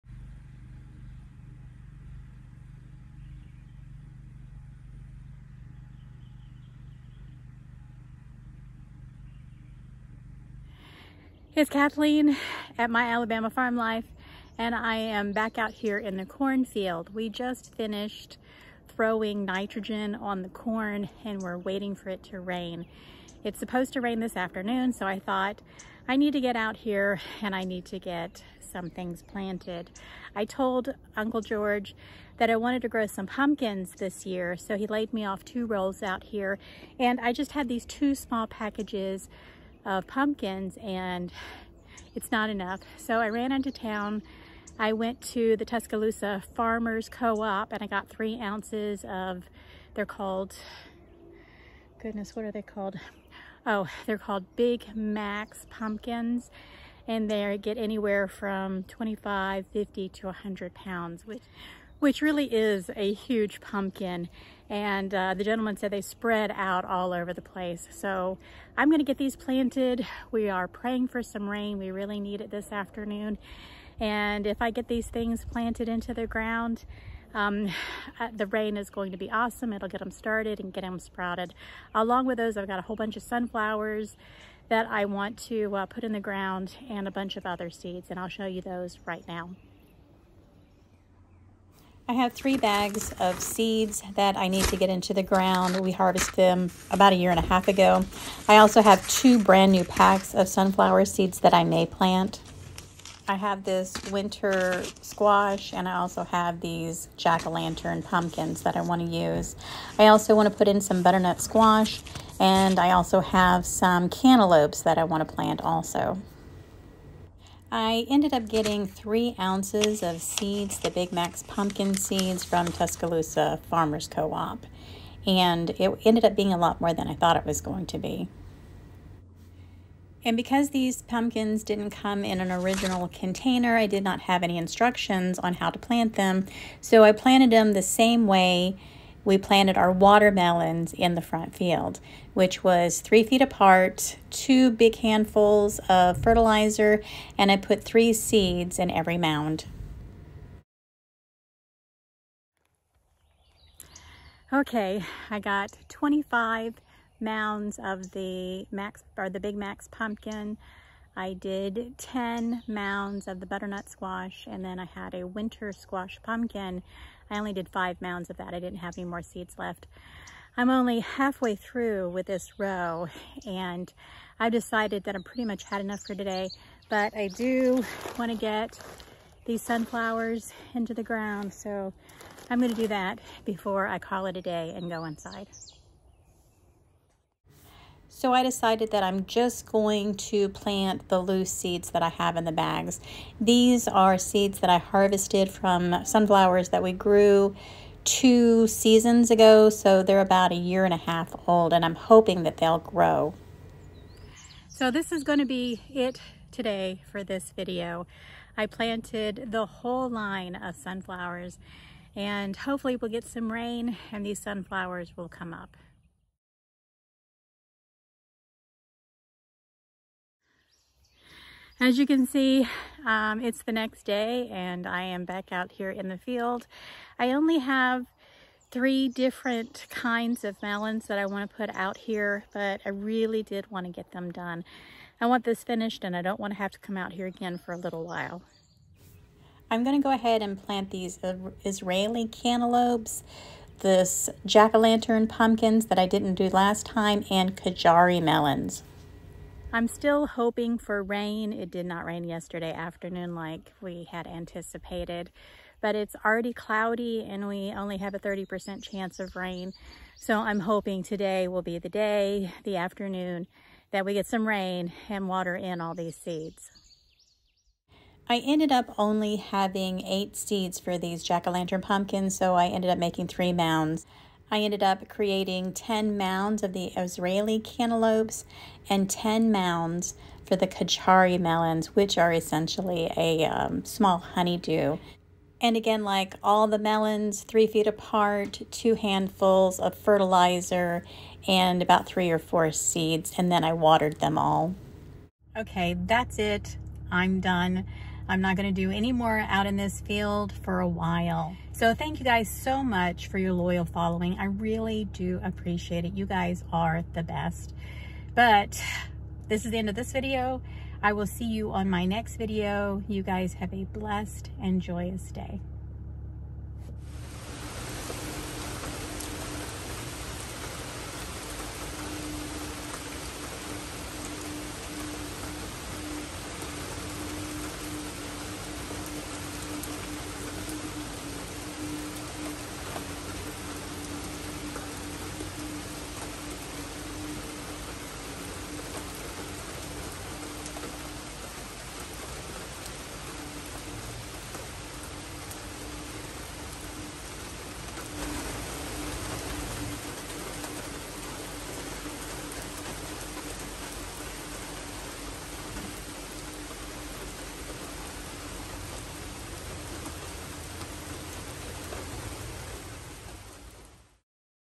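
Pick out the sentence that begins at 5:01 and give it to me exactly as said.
So thank you guys so much for your loyal following.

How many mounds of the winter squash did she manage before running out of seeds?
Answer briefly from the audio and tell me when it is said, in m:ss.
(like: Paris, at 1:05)
5, at 2:47.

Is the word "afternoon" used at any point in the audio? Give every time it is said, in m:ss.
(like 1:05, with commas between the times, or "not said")
0:24, 1:12, 4:12, 4:22.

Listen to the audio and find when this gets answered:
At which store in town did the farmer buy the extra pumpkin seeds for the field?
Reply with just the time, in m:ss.
0:45.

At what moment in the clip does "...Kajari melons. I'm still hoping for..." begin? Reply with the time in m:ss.
4:07.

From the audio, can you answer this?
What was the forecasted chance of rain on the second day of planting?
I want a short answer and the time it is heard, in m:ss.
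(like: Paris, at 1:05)
30%, at 4:18.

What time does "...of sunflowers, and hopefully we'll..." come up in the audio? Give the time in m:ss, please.
3:30.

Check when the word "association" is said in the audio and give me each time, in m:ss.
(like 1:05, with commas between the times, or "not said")
not said.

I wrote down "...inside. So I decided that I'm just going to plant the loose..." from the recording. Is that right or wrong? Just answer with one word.
right.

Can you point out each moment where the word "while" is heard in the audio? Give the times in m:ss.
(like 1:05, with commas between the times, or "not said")
3:58, 5:00.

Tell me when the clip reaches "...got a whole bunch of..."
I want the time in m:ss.
1:22.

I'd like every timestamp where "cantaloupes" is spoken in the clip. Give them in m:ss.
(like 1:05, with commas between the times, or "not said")
1:54, 4:02, 4:37.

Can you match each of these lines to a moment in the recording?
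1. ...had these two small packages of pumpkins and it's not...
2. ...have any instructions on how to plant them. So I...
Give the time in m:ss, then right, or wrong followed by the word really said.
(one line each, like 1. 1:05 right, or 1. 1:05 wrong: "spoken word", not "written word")
1. 0:37 right
2. 2:14 right.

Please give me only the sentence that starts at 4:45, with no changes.
And again, like all the melons, three feet apart, two handfuls of fertilizer, and about three or four seeds.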